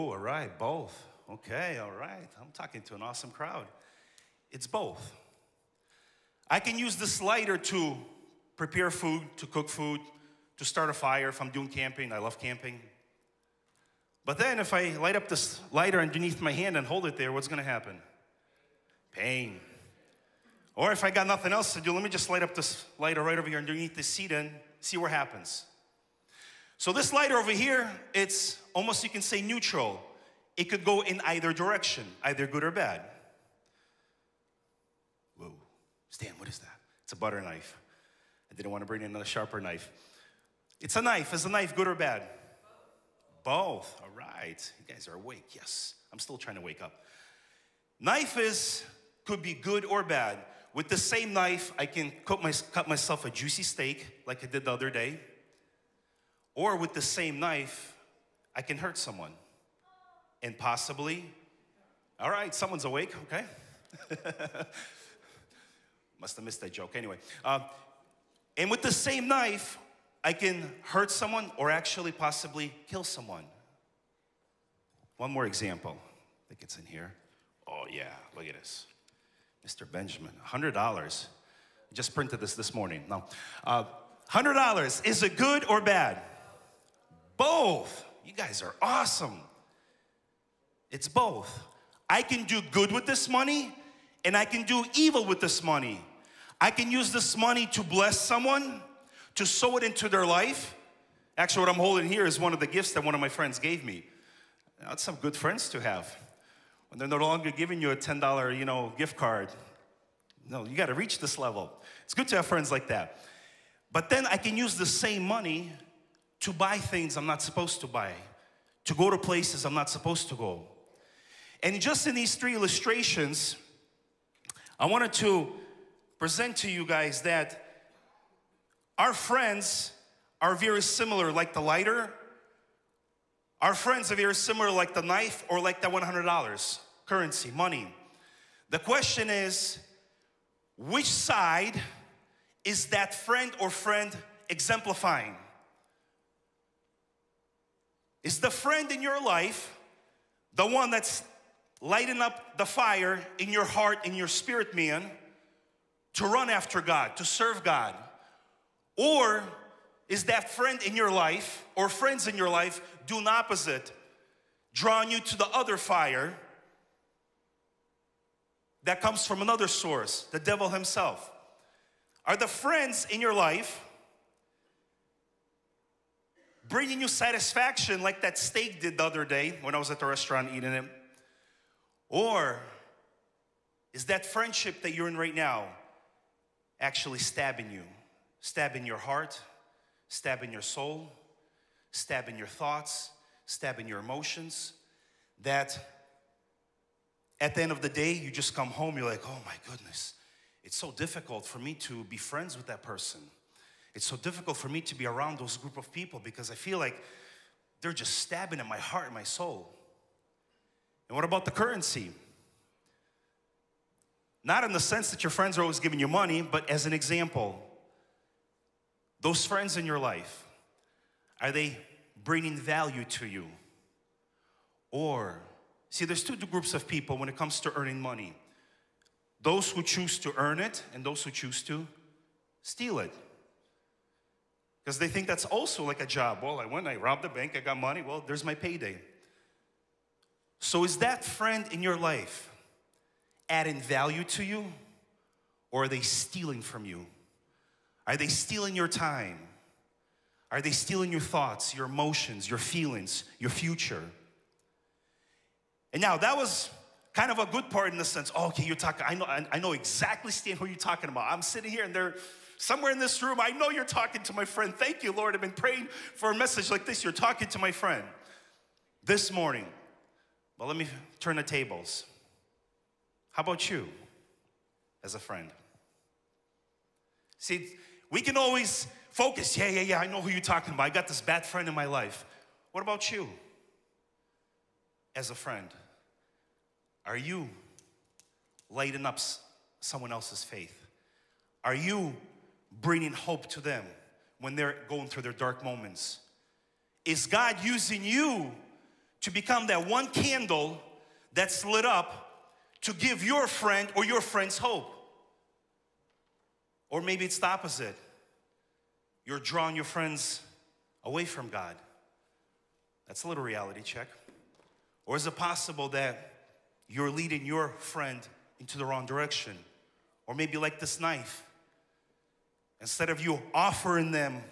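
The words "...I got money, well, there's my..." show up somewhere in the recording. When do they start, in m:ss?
3:57.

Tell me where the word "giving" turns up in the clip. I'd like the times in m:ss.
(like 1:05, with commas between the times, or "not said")
1:47, 3:35.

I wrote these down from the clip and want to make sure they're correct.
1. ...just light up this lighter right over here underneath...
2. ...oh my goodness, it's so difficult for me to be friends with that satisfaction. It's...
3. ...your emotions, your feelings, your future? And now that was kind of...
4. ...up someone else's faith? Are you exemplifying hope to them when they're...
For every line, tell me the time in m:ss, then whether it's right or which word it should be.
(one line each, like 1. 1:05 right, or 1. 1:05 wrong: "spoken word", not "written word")
1. 0:22 right
2. 3:19 wrong: "person", not "satisfaction"
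3. 4:11 right
4. 4:49 wrong: "bringing", not "exemplifying".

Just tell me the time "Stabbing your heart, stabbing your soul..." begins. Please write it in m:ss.
3:08.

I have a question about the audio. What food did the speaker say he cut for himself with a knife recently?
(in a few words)
A juicy steak.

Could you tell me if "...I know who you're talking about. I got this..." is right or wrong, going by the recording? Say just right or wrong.
right.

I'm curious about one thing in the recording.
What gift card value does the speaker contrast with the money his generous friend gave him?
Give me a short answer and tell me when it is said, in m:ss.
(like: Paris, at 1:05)
$10, at 1:47.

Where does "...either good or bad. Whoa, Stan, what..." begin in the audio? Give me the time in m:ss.
0:32.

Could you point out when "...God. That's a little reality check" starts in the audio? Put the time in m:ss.
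5:11.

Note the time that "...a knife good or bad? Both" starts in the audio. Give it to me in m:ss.
0:41.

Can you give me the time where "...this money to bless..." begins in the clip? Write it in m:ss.
1:37.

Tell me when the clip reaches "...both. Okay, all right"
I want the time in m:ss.
0:00.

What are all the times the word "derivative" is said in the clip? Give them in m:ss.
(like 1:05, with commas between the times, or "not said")
not said.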